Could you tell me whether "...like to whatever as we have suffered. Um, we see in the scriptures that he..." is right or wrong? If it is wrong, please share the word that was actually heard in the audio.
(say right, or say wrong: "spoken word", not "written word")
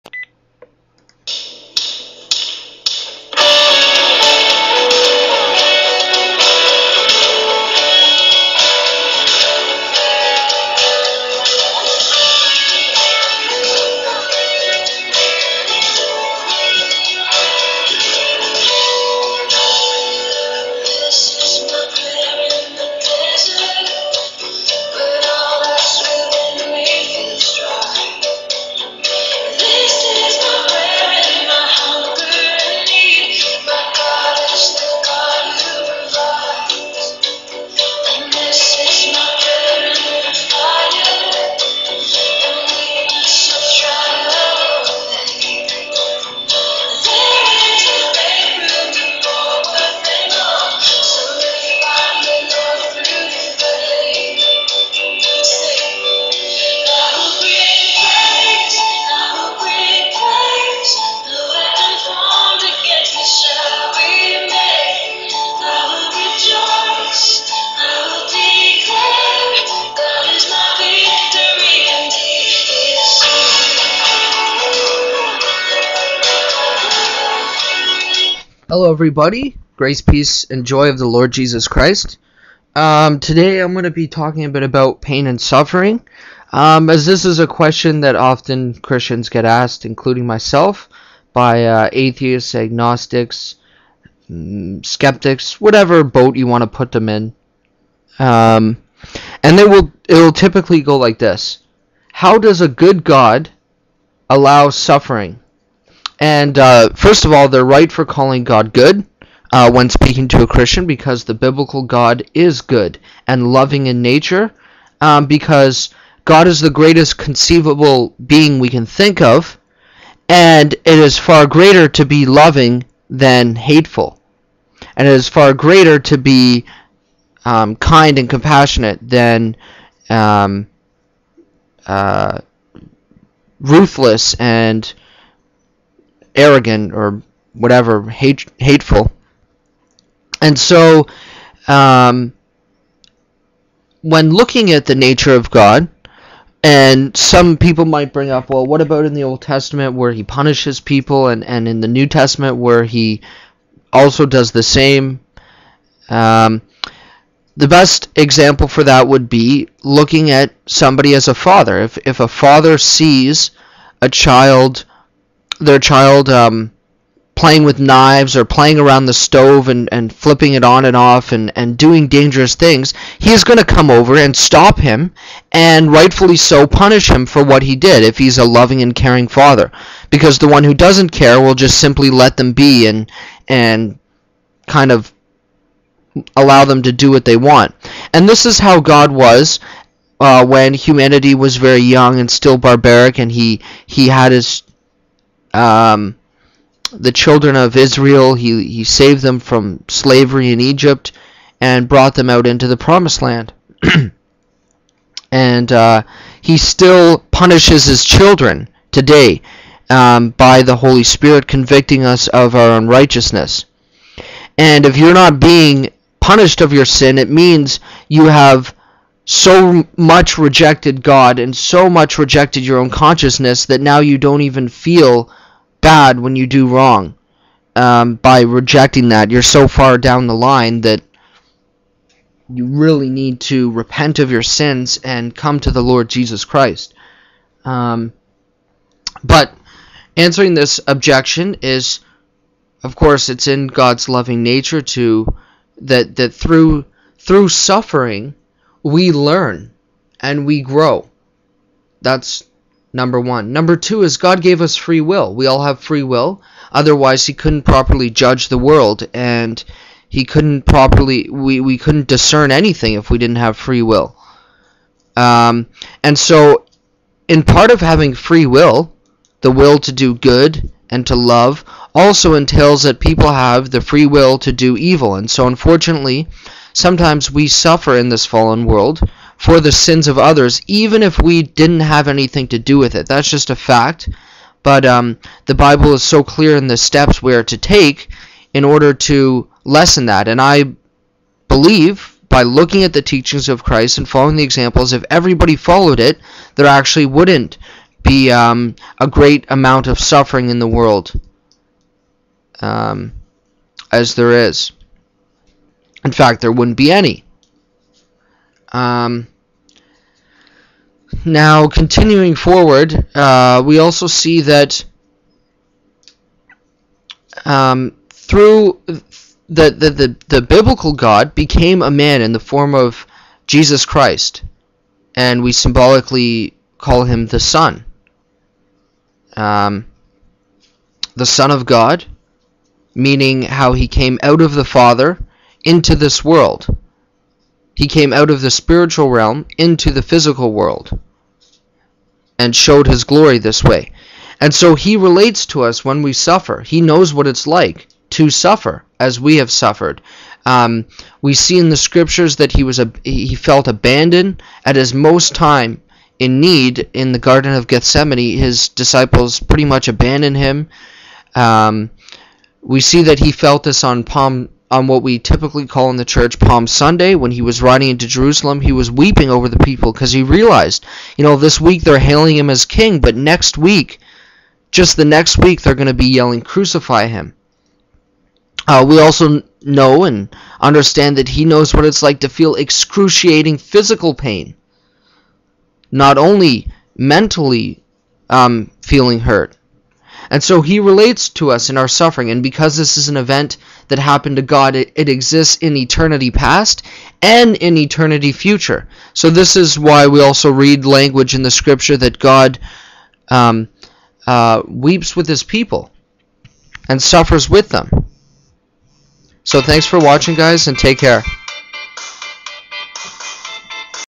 wrong: "suffer", not "whatever".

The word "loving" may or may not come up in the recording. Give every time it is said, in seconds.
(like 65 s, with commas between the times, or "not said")
113 s, 122 s, 178 s, 244 s.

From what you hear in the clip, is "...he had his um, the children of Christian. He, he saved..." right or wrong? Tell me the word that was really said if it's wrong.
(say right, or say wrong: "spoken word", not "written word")
wrong: "Israel", not "Christian".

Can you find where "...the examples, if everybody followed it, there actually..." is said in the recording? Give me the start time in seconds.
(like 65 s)
294 s.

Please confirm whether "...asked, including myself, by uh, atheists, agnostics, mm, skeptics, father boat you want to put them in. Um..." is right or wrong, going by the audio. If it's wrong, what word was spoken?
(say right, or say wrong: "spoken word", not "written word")
wrong: "whatever", not "father".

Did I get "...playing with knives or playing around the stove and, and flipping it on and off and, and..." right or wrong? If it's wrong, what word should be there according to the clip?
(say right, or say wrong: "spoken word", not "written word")
right.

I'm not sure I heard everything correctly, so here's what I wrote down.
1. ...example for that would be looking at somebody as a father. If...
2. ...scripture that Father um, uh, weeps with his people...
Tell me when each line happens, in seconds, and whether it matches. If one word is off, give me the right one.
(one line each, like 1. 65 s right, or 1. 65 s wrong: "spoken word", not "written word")
1. 158 s right
2. 401 s wrong: "God", not "Father".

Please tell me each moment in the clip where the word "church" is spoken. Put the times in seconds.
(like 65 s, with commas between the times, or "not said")
366 s.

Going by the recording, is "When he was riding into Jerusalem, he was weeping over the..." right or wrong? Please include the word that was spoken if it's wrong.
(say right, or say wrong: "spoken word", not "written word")
right.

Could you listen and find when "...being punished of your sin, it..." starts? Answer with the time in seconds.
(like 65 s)
215 s.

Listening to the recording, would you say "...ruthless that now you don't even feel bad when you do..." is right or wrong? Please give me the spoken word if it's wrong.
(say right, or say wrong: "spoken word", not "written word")
wrong: "consciousness", not "ruthless".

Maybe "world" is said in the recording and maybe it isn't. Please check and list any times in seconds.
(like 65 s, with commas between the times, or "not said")
258 s, 278 s, 300 s, 336 s, 340 s.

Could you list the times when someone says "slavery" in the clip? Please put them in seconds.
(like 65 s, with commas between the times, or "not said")
199 s.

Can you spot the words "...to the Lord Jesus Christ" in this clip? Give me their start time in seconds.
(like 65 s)
235 s.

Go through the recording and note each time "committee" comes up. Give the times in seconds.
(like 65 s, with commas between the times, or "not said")
not said.